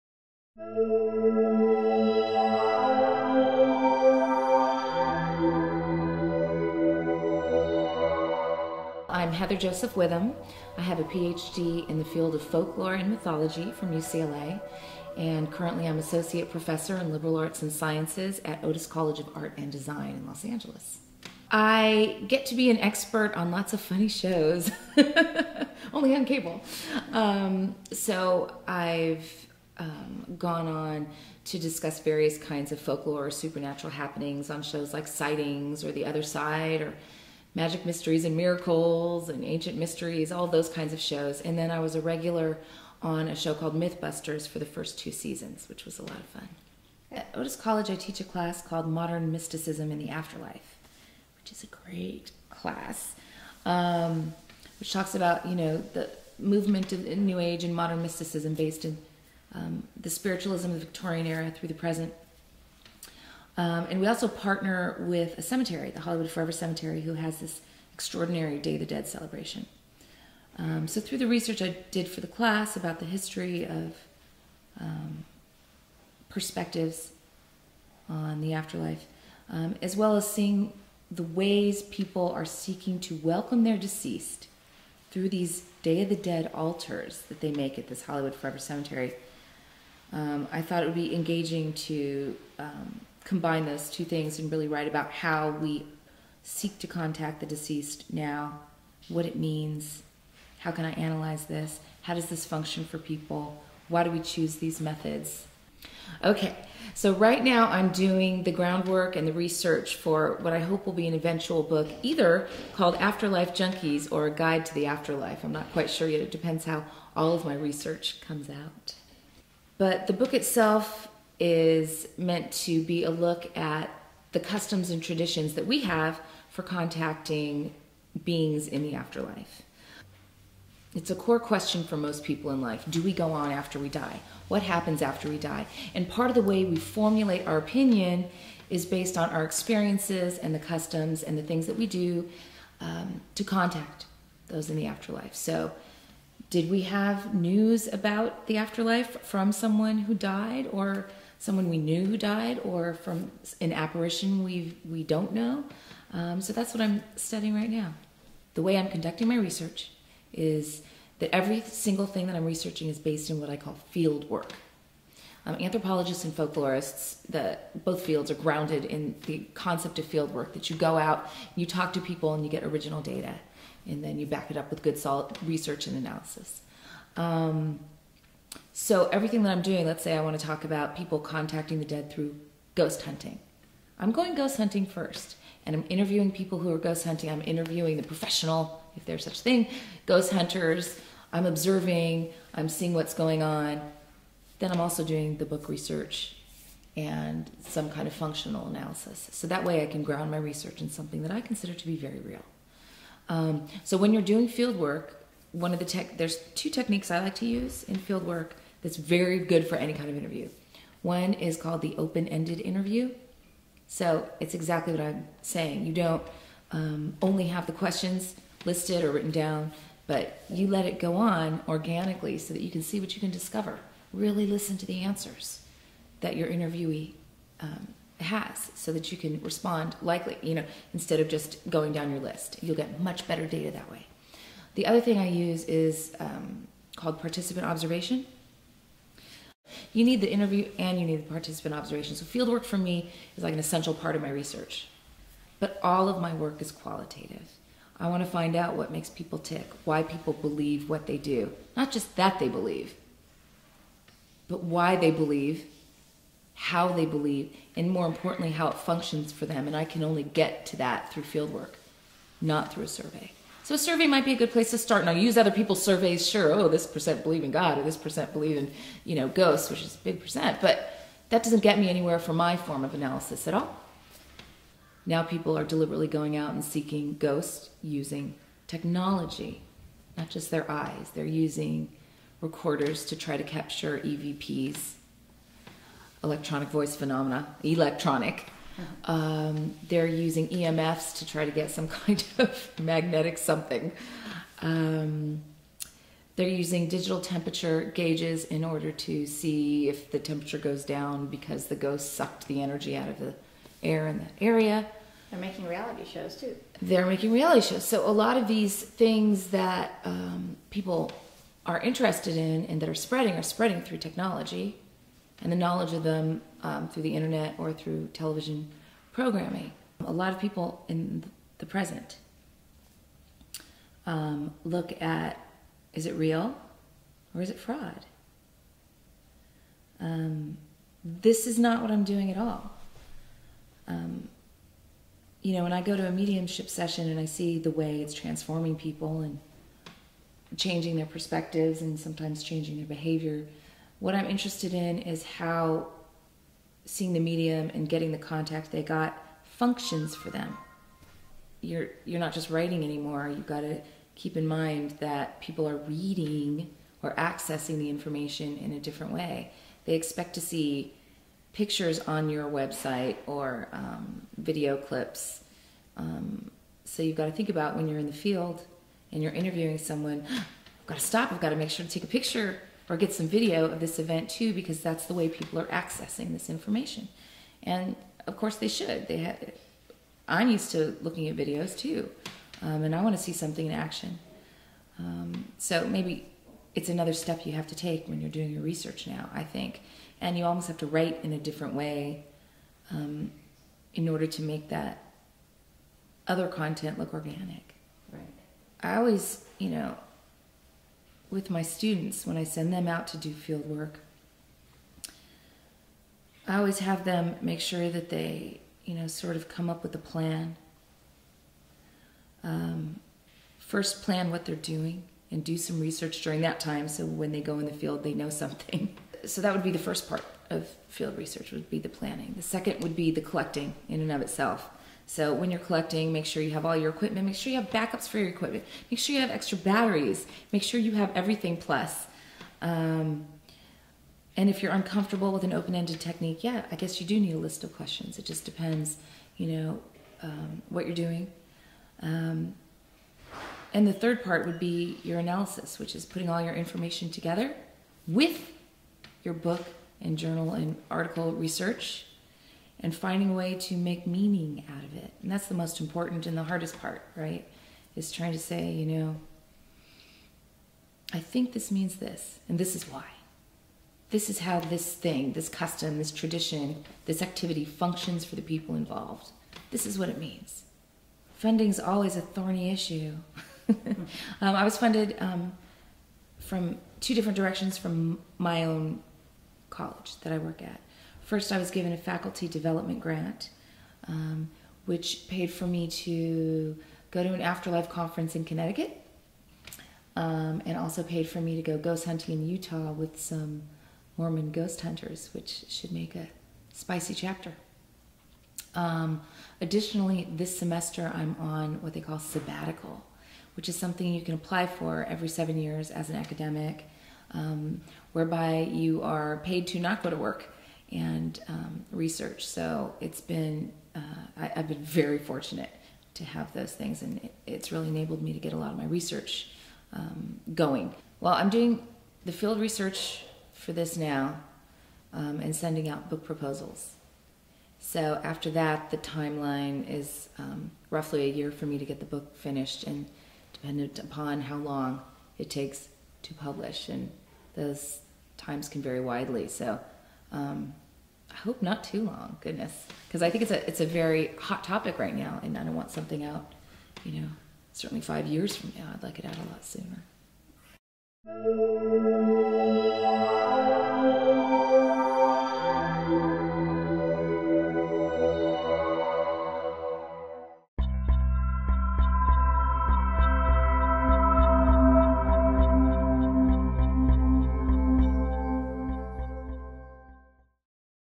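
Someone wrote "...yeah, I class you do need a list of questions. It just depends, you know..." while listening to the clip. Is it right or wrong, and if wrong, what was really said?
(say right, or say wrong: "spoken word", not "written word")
wrong: "guess", not "class".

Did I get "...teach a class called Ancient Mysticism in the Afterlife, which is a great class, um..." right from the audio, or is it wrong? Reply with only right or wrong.
wrong.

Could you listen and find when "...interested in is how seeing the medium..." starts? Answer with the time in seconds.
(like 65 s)
344 s.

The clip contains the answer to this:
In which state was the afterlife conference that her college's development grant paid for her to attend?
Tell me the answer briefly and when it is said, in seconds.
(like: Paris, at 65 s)
Connecticut, at 488 s.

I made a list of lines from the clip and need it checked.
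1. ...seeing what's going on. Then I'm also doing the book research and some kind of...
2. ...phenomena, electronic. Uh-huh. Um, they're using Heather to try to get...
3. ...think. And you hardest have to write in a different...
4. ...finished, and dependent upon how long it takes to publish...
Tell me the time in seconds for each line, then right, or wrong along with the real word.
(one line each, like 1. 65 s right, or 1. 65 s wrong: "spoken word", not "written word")
1. 192 s right
2. 286 s wrong: "EMFs", not "Heather"
3. 389 s wrong: "almost", not "hardest"
4. 532 s right.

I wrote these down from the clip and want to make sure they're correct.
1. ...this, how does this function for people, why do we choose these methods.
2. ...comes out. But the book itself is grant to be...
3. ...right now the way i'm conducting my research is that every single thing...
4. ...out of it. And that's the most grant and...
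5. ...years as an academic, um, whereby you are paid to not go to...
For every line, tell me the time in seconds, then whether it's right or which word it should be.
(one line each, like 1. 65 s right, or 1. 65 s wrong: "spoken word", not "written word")
1. 101 s right
2. 118 s wrong: "meant", not "grant"
3. 157 s right
4. 454 s wrong: "important", not "grant"
5. 505 s right.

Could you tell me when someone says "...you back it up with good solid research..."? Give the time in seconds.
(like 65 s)
174 s.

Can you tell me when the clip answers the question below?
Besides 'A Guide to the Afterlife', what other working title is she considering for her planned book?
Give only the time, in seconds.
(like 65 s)
112 s.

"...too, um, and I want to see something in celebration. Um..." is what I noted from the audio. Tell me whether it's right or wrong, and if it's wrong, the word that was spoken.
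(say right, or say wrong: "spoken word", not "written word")
wrong: "action", not "celebration".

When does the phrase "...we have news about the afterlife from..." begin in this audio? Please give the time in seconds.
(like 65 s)
146 s.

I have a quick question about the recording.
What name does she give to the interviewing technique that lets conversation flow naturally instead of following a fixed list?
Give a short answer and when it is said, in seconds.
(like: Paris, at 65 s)
open-ended interview, at 211 s.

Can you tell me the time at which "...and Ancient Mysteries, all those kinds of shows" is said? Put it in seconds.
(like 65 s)
39 s.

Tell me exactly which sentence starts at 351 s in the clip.
You're you're not just writing anymore.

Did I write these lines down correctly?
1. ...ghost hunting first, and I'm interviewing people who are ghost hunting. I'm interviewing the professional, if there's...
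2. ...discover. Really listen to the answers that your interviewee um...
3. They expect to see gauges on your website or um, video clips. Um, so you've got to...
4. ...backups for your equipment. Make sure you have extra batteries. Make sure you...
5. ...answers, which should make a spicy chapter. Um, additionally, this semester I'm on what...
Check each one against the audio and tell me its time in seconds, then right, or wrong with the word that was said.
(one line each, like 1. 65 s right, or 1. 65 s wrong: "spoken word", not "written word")
1. 184 s right
2. 223 s right
3. 359 s wrong: "pictures", not "gauges"
4. 427 s right
5. 494 s wrong: "hunters", not "answers".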